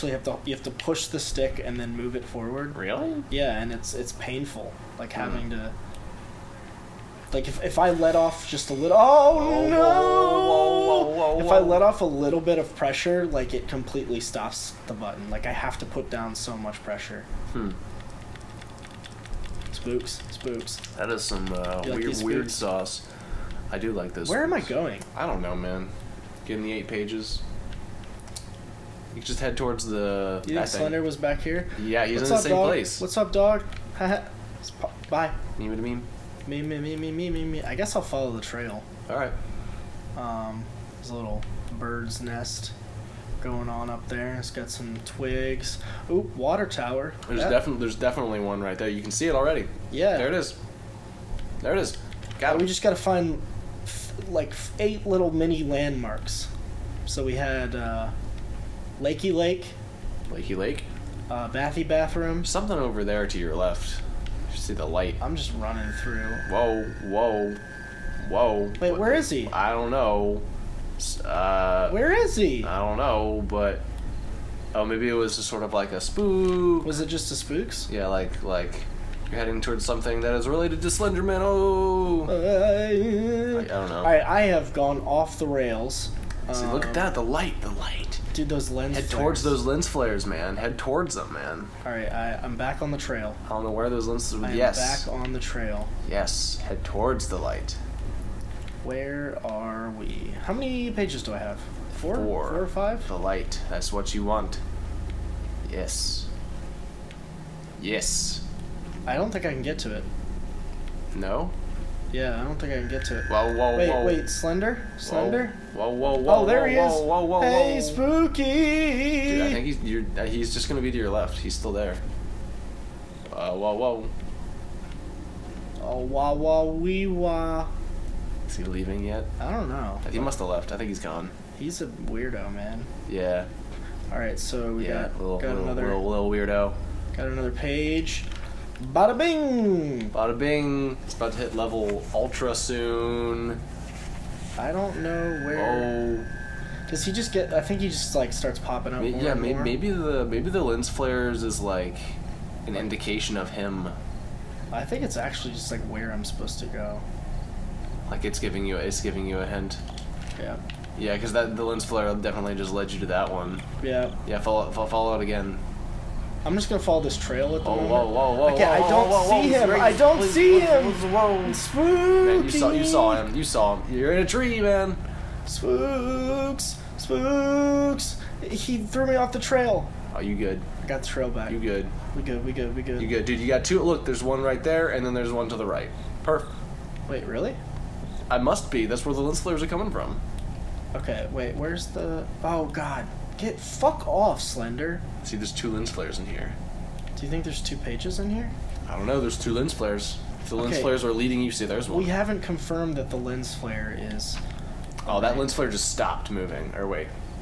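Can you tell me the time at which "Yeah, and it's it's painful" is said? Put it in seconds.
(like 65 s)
3 s.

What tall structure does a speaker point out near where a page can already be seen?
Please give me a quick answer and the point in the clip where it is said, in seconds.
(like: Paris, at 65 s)
water tower, at 46 s.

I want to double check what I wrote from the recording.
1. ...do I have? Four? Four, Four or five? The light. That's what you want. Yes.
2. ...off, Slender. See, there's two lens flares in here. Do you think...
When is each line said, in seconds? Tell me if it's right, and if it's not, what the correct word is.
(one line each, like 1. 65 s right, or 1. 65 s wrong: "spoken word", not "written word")
1. 101 s right
2. 194 s right.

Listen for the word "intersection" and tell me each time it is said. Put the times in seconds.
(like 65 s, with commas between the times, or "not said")
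not said.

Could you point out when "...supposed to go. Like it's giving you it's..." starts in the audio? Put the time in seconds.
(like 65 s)
156 s.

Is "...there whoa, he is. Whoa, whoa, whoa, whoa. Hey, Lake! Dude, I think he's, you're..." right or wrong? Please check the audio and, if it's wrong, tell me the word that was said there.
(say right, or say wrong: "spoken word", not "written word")
wrong: "Spooky", not "Lake".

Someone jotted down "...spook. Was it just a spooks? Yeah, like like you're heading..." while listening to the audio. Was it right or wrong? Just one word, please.
right.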